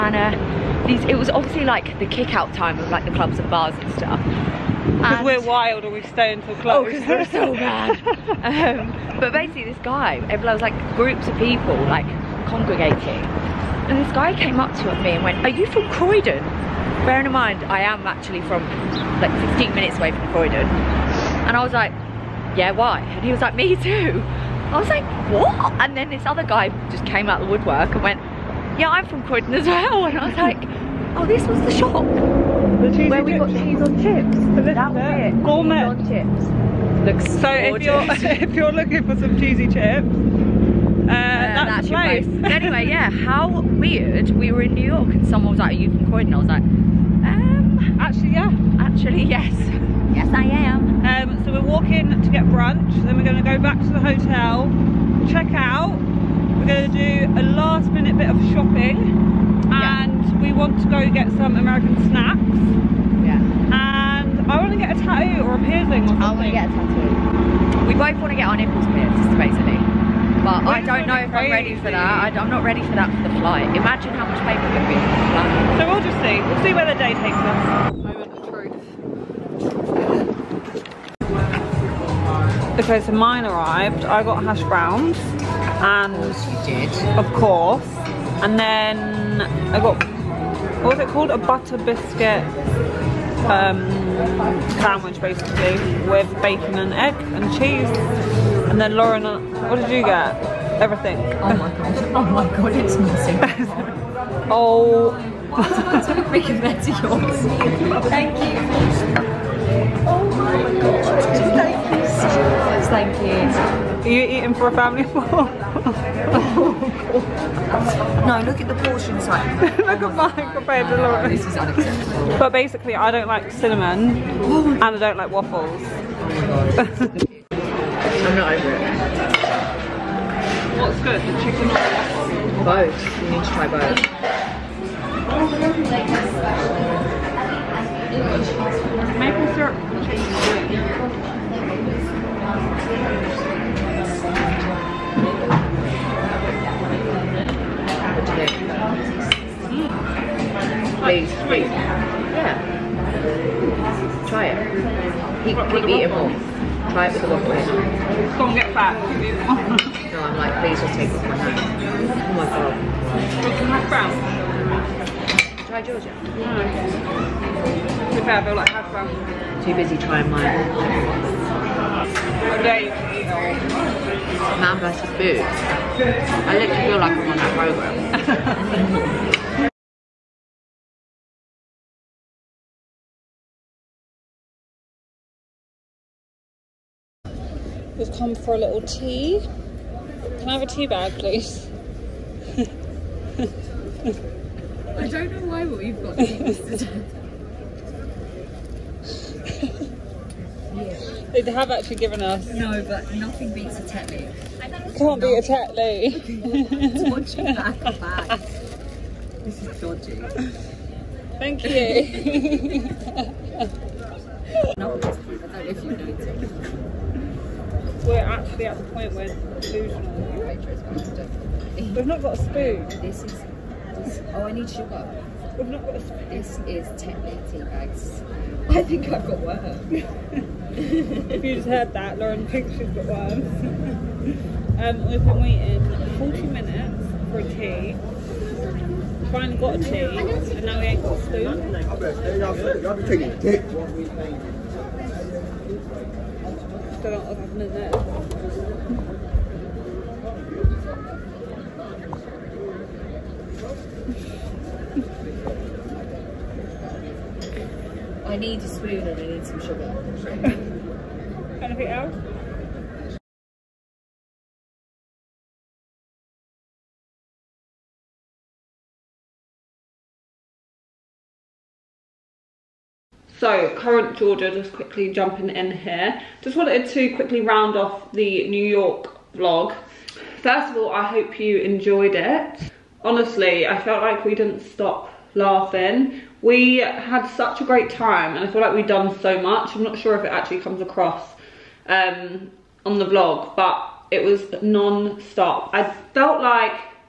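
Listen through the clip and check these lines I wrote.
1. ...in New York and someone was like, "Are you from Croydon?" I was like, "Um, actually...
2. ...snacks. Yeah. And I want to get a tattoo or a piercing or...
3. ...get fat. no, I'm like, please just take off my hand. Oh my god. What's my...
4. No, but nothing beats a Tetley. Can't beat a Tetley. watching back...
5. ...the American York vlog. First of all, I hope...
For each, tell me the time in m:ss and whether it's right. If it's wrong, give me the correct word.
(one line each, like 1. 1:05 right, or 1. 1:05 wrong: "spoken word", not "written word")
1. 0:44 right
2. 1:02 right
3. 2:38 right
4. 3:22 right
5. 4:38 wrong: "New", not "American".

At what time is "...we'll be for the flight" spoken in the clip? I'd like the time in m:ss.
1:14.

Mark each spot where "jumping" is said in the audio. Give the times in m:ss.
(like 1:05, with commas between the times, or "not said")
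4:35.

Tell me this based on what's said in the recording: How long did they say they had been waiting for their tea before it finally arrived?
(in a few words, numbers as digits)
40 minutes.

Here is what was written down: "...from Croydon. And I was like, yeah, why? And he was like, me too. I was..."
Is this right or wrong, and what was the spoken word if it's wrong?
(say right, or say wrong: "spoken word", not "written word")
right.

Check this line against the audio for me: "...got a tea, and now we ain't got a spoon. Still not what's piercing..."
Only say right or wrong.
wrong.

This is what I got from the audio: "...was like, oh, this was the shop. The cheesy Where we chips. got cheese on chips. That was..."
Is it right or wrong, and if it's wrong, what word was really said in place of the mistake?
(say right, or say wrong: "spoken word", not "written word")
right.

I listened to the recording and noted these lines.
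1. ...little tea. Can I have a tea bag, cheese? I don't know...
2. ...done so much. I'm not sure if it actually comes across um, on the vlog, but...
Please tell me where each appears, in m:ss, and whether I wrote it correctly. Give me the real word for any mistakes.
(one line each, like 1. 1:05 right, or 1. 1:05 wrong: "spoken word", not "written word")
1. 3:08 wrong: "please", not "cheese"
2. 4:48 right.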